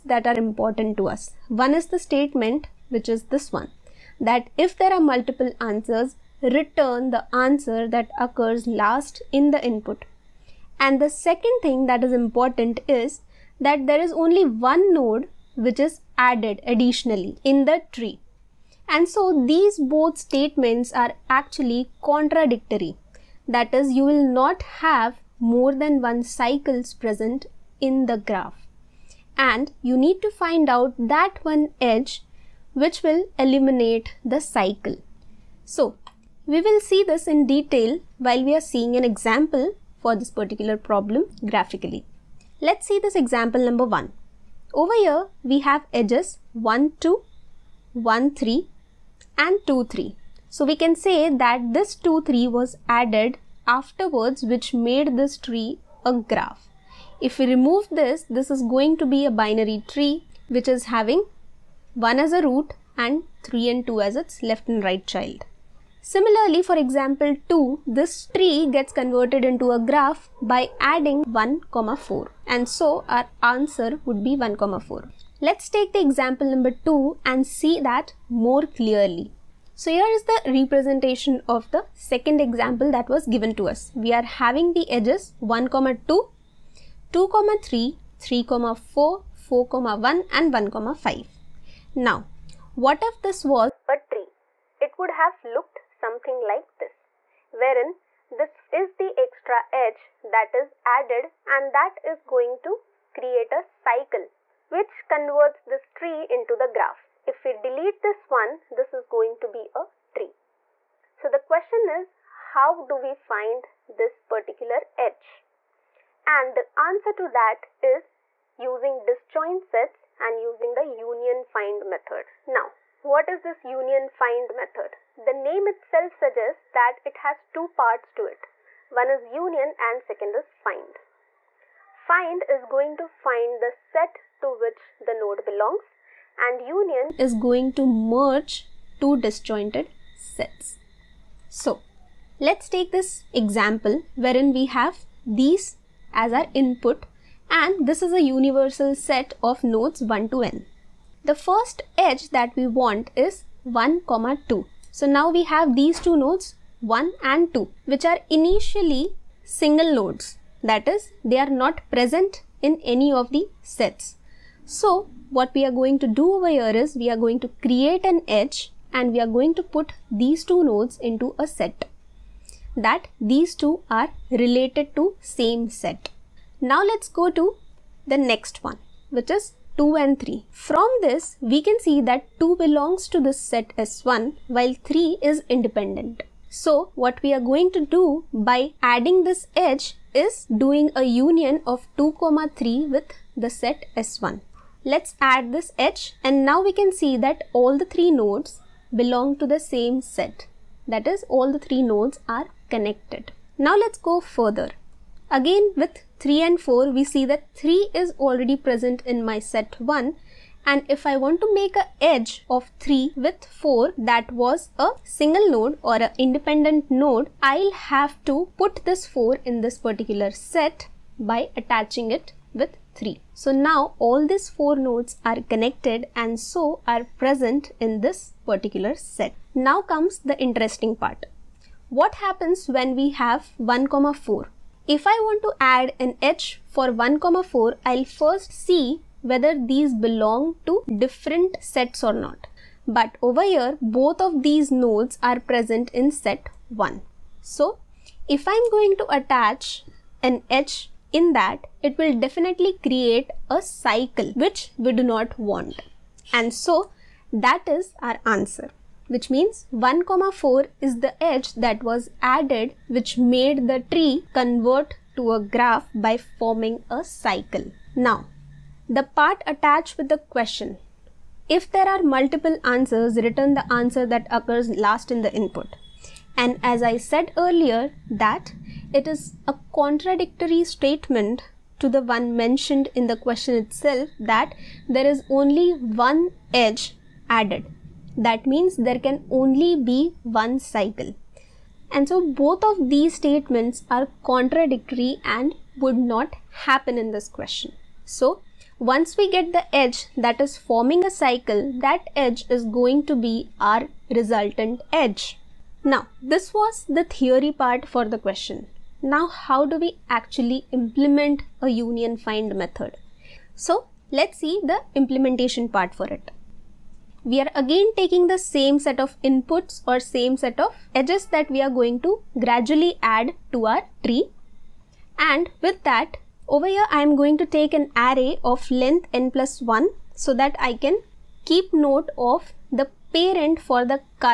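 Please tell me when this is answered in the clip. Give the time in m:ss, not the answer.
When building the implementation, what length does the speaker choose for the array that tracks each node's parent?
5:29.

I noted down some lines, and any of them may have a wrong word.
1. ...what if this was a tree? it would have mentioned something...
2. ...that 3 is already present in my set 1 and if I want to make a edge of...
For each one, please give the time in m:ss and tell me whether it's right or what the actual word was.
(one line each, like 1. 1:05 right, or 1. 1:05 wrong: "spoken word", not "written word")
1. 1:32 wrong: "looked", not "mentioned"
2. 3:27 right.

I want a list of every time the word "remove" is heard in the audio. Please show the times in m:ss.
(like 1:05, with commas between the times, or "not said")
0:57.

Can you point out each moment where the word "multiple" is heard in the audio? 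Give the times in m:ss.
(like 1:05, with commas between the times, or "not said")
0:05, 4:32.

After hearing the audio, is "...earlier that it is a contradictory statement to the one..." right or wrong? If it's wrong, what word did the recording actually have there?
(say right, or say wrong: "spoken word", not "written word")
right.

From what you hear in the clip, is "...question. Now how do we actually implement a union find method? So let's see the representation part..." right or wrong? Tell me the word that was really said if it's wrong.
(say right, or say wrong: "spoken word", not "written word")
wrong: "implementation", not "representation".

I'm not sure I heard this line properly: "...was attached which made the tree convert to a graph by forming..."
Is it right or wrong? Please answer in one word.
wrong.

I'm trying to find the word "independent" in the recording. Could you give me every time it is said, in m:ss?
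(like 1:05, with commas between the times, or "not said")
3:05, 3:36.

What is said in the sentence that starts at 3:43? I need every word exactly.
So now all these 4 nodes are connected and so are present in this particular set.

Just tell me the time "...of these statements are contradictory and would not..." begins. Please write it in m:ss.
4:52.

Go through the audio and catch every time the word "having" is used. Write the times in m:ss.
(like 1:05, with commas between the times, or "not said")
1:00, 1:24.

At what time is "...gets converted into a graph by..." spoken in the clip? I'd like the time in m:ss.
1:08.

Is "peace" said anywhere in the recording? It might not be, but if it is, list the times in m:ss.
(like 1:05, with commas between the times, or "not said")
not said.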